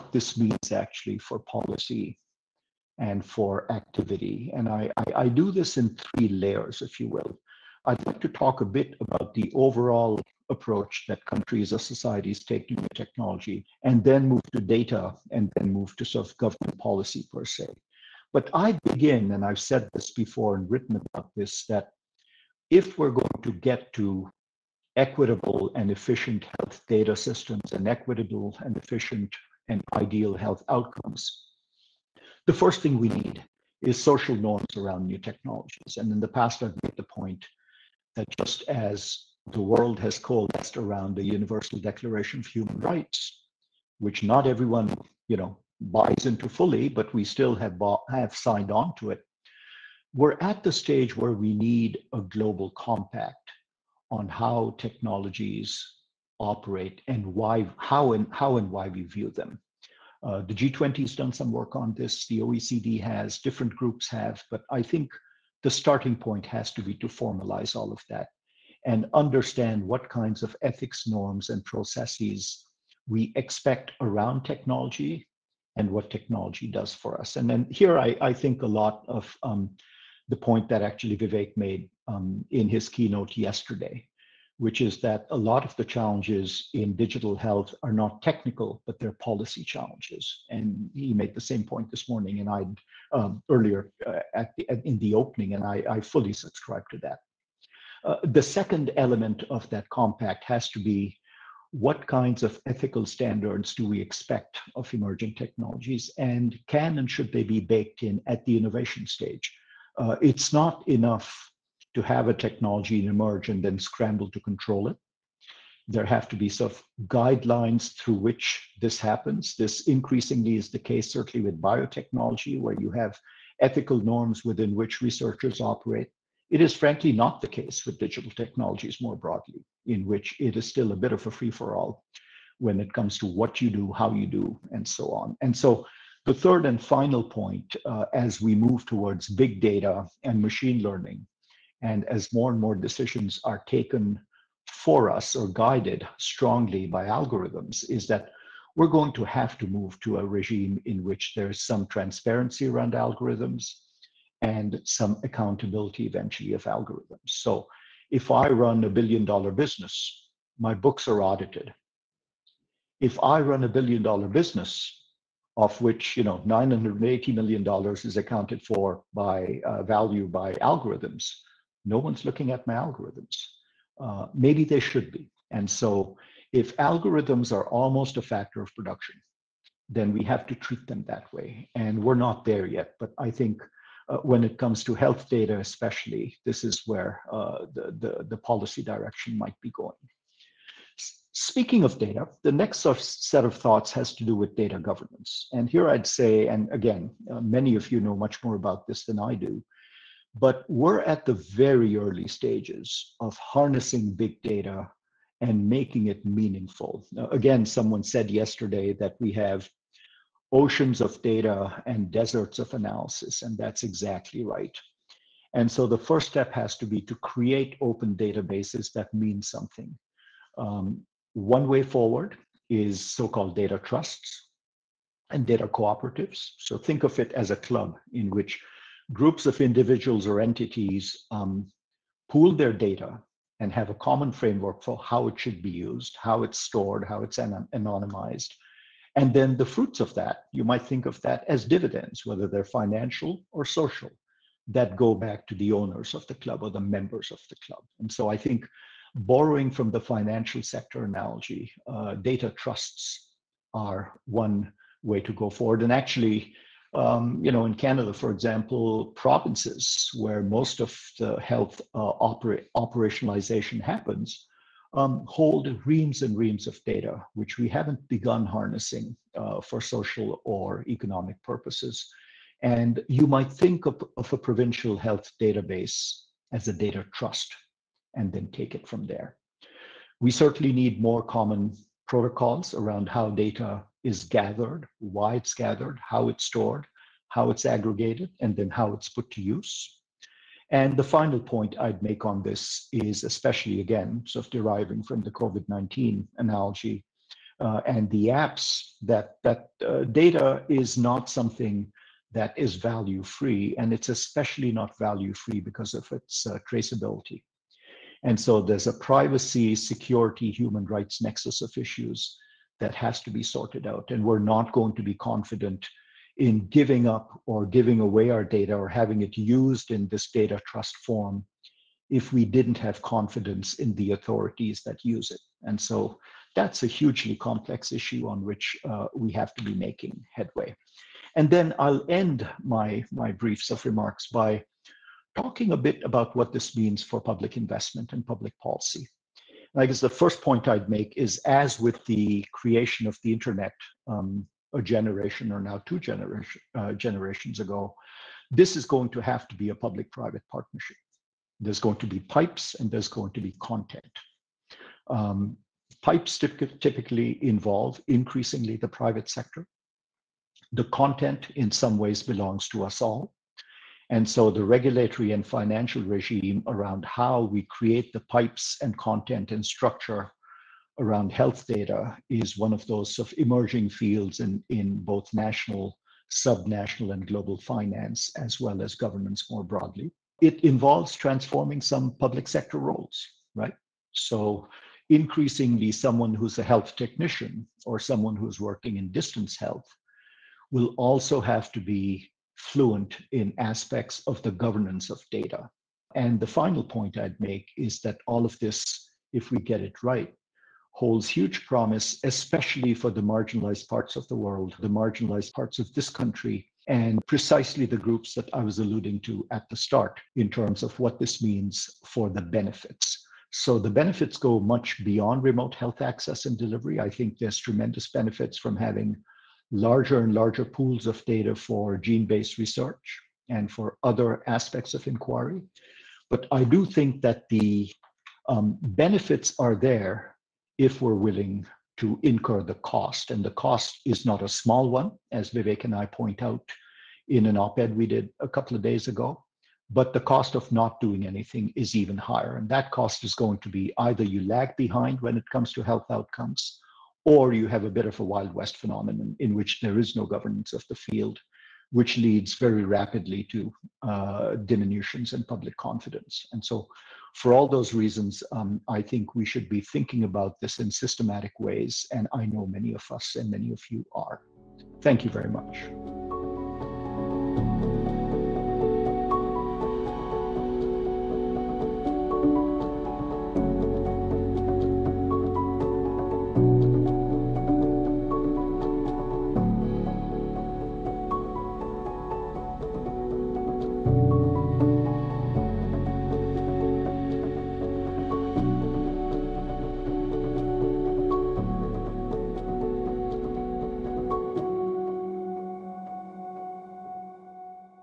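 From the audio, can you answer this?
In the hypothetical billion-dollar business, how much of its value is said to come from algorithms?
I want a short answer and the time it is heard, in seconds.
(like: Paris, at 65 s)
980 million dollars, at 166 s.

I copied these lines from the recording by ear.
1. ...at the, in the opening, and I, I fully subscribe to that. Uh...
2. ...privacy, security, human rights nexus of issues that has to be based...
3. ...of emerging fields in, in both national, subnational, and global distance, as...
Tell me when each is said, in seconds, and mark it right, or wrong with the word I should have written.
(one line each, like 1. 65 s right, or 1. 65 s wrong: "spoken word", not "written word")
1. 94 s right
2. 308 s wrong: "sorted", not "based"
3. 373 s wrong: "finance", not "distance".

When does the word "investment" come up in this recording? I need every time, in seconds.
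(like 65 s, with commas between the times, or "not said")
337 s.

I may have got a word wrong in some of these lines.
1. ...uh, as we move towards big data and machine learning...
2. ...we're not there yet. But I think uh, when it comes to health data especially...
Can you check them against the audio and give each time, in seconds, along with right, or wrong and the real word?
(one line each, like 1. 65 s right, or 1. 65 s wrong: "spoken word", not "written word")
1. 137 s right
2. 182 s right.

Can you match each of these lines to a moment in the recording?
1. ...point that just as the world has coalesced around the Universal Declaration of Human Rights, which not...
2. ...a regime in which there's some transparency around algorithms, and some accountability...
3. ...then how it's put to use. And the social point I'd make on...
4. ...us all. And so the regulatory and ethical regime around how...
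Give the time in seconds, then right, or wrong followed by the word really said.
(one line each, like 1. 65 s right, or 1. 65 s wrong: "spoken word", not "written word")
1. 37 s right
2. 150 s right
3. 288 s wrong: "final", not "social"
4. 362 s wrong: "financial", not "ethical".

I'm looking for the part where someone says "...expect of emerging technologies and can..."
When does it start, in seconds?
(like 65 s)
103 s.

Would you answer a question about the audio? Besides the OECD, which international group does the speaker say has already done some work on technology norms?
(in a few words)
G20.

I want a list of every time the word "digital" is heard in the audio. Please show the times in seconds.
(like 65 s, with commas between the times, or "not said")
86 s, 127 s.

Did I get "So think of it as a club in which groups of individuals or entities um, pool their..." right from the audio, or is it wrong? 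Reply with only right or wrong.
right.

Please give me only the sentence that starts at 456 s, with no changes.
And so for all those reasons, um, I think we should be thinking about this in systematic ways.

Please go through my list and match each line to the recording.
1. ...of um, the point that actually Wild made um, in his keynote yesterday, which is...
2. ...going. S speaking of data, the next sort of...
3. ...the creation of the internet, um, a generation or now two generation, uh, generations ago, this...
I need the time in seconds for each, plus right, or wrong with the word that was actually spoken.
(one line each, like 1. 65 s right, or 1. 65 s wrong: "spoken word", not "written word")
1. 79 s wrong: "Vivek", not "Wild"
2. 189 s right
3. 342 s right.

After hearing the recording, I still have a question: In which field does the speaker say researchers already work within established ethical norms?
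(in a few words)
biotechnology.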